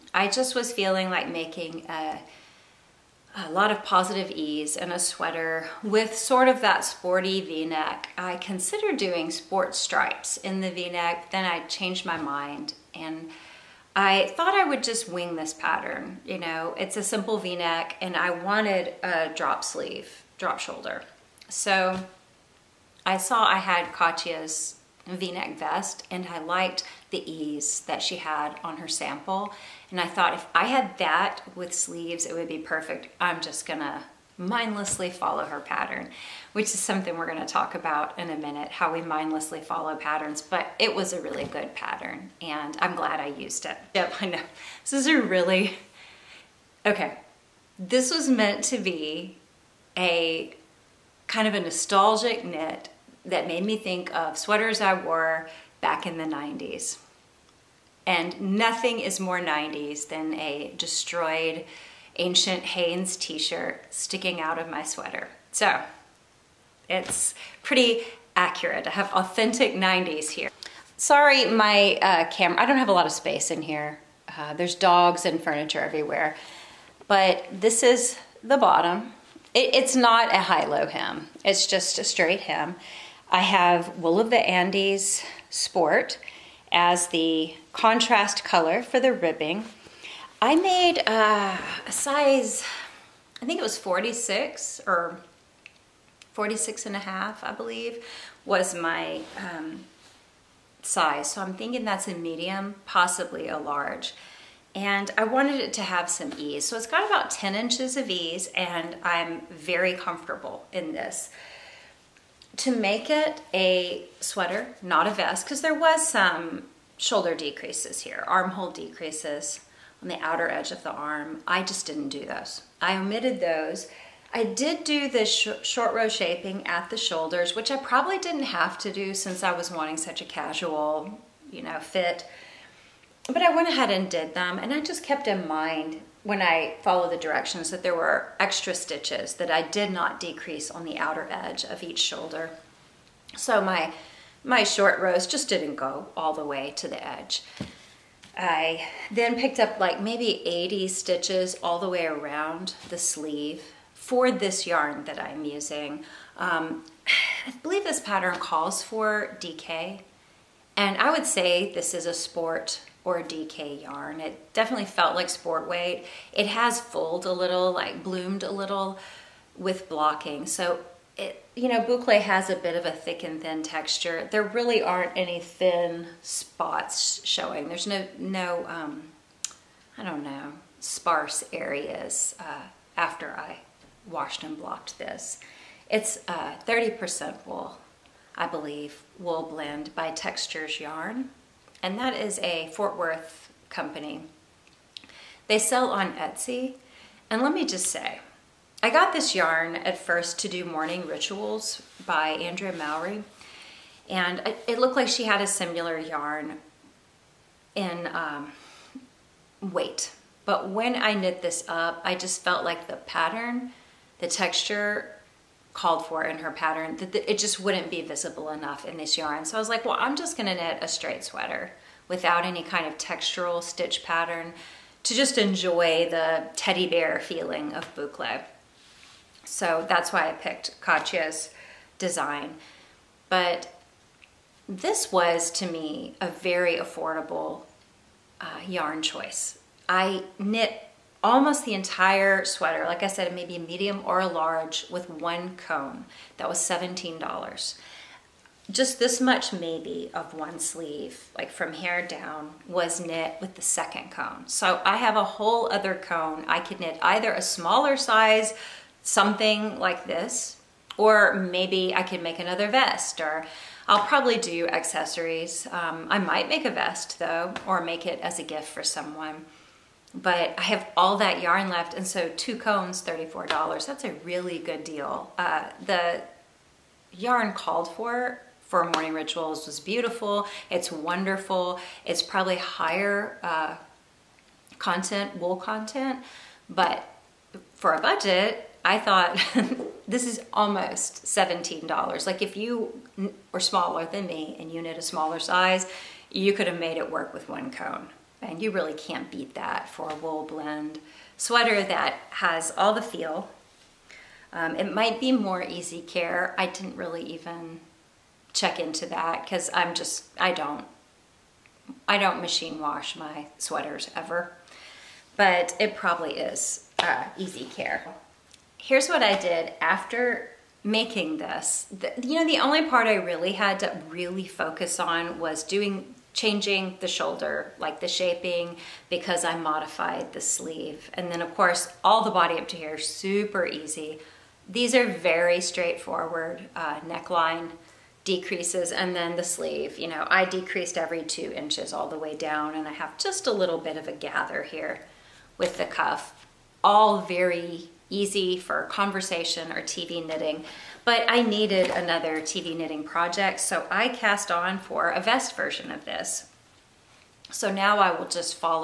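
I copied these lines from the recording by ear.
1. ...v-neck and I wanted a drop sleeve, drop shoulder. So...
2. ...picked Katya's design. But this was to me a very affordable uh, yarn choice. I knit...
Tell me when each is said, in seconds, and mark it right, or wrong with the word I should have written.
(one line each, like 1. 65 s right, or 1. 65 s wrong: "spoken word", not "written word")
1. 17 s right
2. 230 s right.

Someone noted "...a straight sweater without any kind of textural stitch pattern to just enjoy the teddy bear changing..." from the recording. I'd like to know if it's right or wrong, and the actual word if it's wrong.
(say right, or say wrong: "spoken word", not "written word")
wrong: "feeling", not "changing".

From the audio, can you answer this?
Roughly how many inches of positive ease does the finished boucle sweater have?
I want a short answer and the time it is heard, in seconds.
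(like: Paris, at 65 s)
10, at 107 s.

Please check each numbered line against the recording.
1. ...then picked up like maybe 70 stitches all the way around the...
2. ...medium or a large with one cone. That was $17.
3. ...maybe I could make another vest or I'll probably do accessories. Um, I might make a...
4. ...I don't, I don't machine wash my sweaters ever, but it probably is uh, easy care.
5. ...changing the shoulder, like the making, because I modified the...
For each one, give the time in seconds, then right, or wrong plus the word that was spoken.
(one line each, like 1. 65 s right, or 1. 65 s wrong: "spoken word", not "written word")
1. 149 s wrong: "80", not "70"
2. 243 s right
3. 261 s right
4. 310 s right
5. 326 s wrong: "shaping", not "making".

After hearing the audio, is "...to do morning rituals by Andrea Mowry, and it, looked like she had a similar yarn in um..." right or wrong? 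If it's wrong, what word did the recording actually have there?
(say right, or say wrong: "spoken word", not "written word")
right.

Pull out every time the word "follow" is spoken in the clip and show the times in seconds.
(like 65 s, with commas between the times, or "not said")
35 s, 39 s, 136 s.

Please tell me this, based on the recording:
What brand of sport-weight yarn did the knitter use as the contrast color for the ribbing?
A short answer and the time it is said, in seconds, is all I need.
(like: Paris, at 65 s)
Wool of the Andes, at 83 s.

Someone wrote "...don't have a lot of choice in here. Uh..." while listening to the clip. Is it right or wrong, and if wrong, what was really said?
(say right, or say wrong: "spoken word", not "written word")
wrong: "space", not "choice".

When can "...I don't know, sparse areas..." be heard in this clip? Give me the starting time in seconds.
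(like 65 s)
179 s.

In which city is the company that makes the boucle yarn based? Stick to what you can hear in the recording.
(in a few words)
Fort Worth.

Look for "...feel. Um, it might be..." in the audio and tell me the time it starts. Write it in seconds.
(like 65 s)
303 s.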